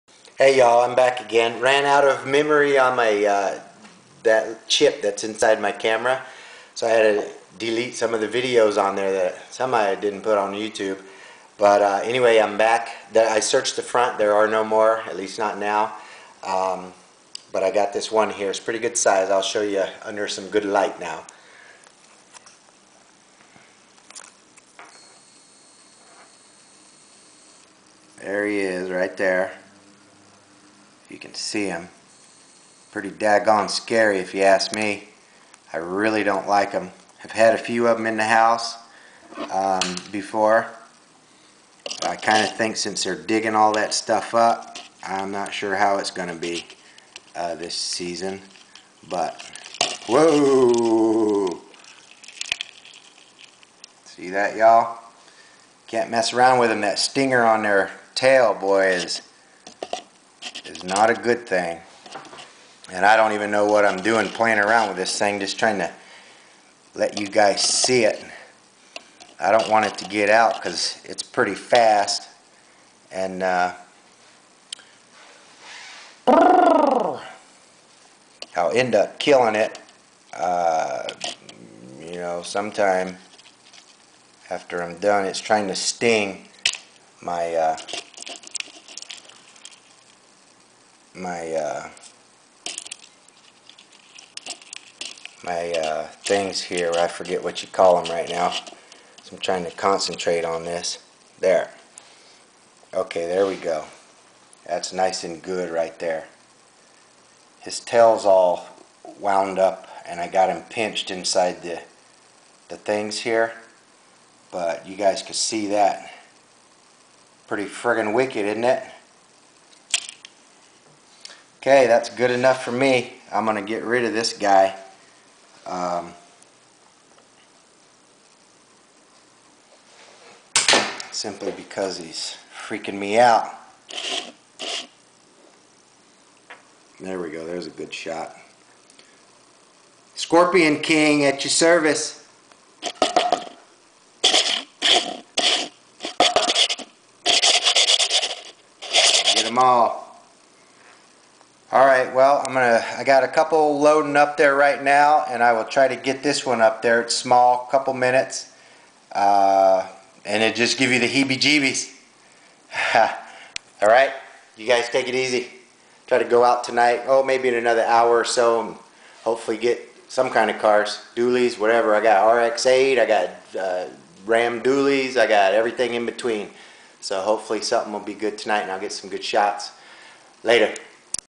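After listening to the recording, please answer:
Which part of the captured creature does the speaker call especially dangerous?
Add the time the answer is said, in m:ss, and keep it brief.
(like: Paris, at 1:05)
Stinger on their tail, at 0:56.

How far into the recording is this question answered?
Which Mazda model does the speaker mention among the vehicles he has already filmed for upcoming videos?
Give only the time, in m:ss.
2:52.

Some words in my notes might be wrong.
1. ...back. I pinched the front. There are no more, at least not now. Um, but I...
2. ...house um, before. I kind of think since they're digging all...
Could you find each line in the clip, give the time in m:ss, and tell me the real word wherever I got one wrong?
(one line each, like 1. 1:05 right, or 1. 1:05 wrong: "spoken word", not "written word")
1. 0:12 wrong: "searched", not "pinched"
2. 0:38 right.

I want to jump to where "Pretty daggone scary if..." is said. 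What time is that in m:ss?
0:32.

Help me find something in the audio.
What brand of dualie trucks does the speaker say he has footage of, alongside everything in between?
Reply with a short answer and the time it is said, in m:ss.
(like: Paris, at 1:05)
Ram, at 2:54.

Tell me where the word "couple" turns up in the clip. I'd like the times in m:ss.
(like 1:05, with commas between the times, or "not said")
2:33, 2:37.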